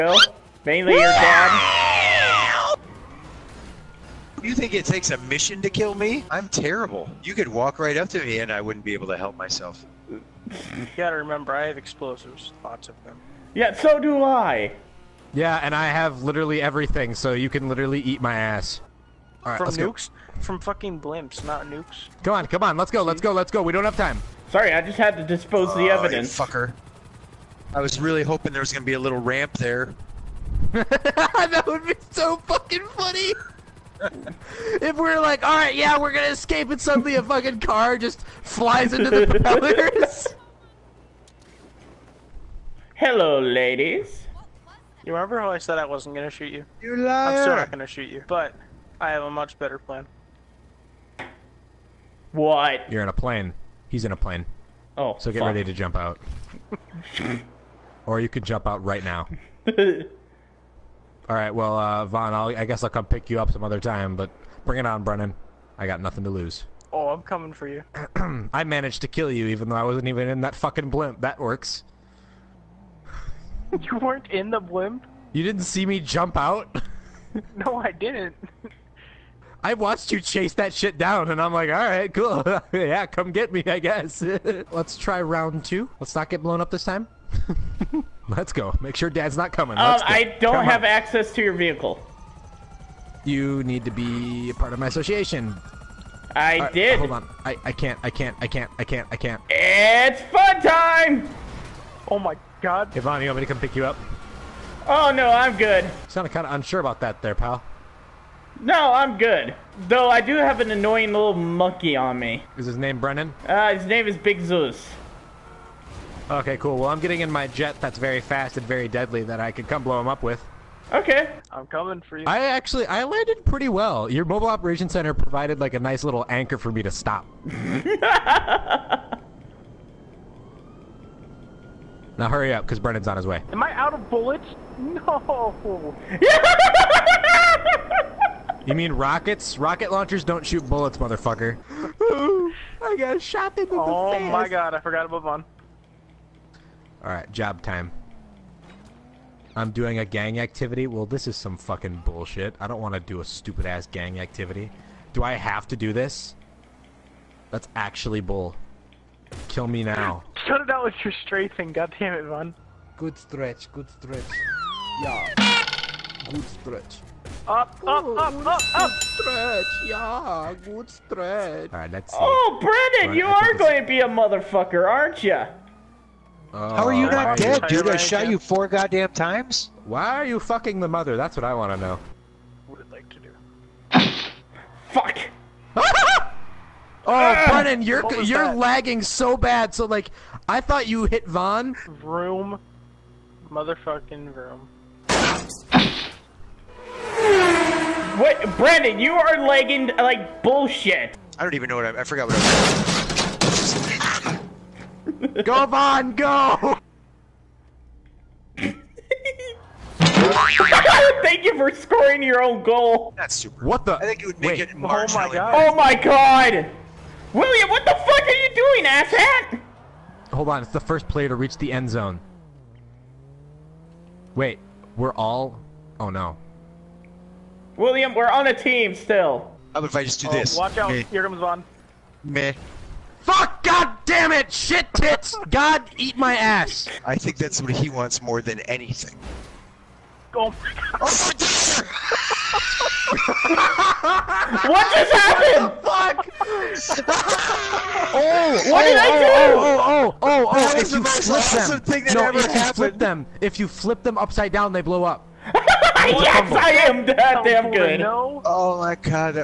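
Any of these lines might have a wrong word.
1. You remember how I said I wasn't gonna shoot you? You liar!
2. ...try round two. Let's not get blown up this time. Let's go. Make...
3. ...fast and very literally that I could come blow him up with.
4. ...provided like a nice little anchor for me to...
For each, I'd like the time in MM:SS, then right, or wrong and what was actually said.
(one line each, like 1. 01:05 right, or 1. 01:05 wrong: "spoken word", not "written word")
1. 00:45 right
2. 01:24 right
3. 01:58 wrong: "deadly", not "literally"
4. 02:05 right.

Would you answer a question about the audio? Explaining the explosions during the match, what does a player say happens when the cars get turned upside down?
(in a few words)
They blow up.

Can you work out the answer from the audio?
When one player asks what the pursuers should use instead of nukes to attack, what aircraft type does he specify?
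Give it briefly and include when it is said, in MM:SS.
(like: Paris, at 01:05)
Blimps, at 00:20.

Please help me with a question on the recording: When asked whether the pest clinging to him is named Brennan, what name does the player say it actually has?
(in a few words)
Big Zeus.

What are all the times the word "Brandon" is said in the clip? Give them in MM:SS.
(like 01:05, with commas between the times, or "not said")
03:07.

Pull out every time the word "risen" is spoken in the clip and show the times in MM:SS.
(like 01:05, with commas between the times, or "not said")
not said.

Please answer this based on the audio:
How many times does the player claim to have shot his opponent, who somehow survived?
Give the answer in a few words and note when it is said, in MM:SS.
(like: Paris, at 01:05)
4, at 02:58.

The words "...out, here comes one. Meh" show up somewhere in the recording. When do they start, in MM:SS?
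03:50.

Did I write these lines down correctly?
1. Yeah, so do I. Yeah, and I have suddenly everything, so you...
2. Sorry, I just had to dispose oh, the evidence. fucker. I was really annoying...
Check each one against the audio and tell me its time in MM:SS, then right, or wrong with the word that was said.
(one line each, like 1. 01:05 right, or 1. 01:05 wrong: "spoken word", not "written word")
1. 00:13 wrong: "literally", not "suddenly"
2. 00:24 wrong: "hoping", not "annoying".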